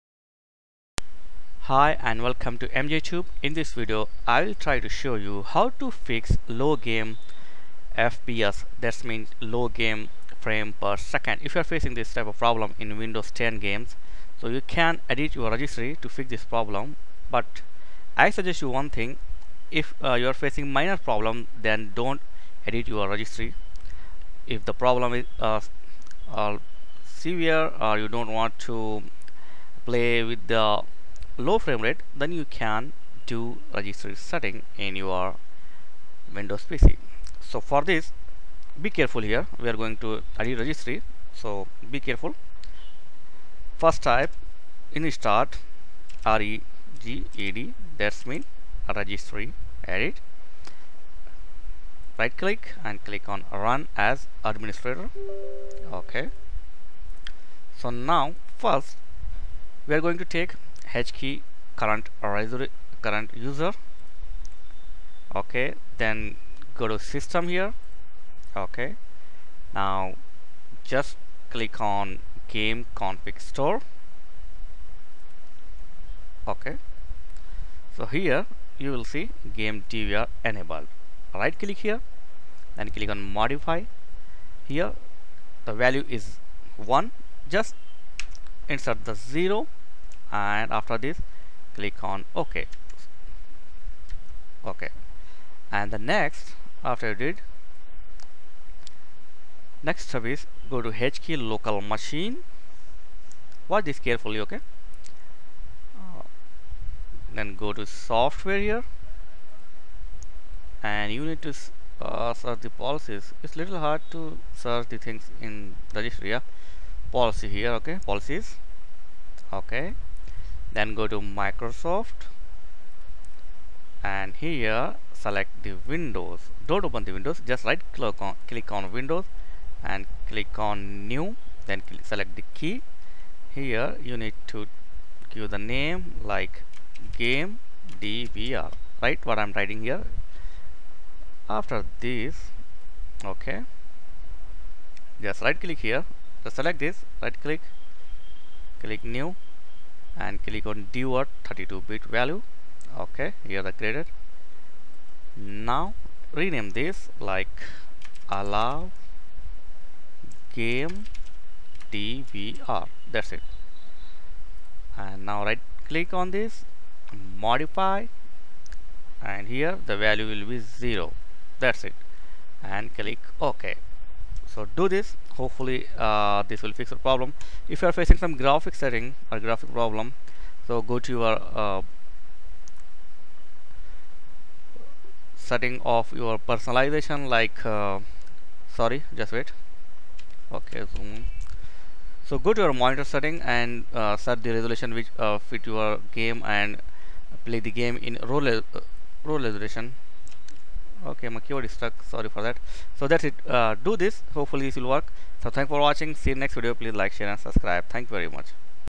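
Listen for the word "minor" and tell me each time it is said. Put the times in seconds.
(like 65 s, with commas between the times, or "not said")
20 s.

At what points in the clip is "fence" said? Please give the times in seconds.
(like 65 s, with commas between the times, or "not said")
not said.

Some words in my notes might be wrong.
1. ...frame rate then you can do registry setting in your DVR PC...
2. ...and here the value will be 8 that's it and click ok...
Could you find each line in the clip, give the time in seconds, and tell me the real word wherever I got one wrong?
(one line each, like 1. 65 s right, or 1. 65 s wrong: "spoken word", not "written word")
1. 31 s wrong: "Windows", not "DVR"
2. 169 s wrong: "0", not "8".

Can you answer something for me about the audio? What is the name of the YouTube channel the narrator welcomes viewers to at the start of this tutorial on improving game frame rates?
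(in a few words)
MJTube.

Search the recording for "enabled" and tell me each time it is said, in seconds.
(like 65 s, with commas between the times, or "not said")
80 s.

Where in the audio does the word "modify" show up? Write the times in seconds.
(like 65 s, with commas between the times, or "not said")
83 s, 167 s.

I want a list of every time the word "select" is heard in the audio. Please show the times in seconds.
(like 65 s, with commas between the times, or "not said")
125 s, 132 s, 146 s.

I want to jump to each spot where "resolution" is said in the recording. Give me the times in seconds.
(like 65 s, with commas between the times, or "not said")
194 s, 199 s.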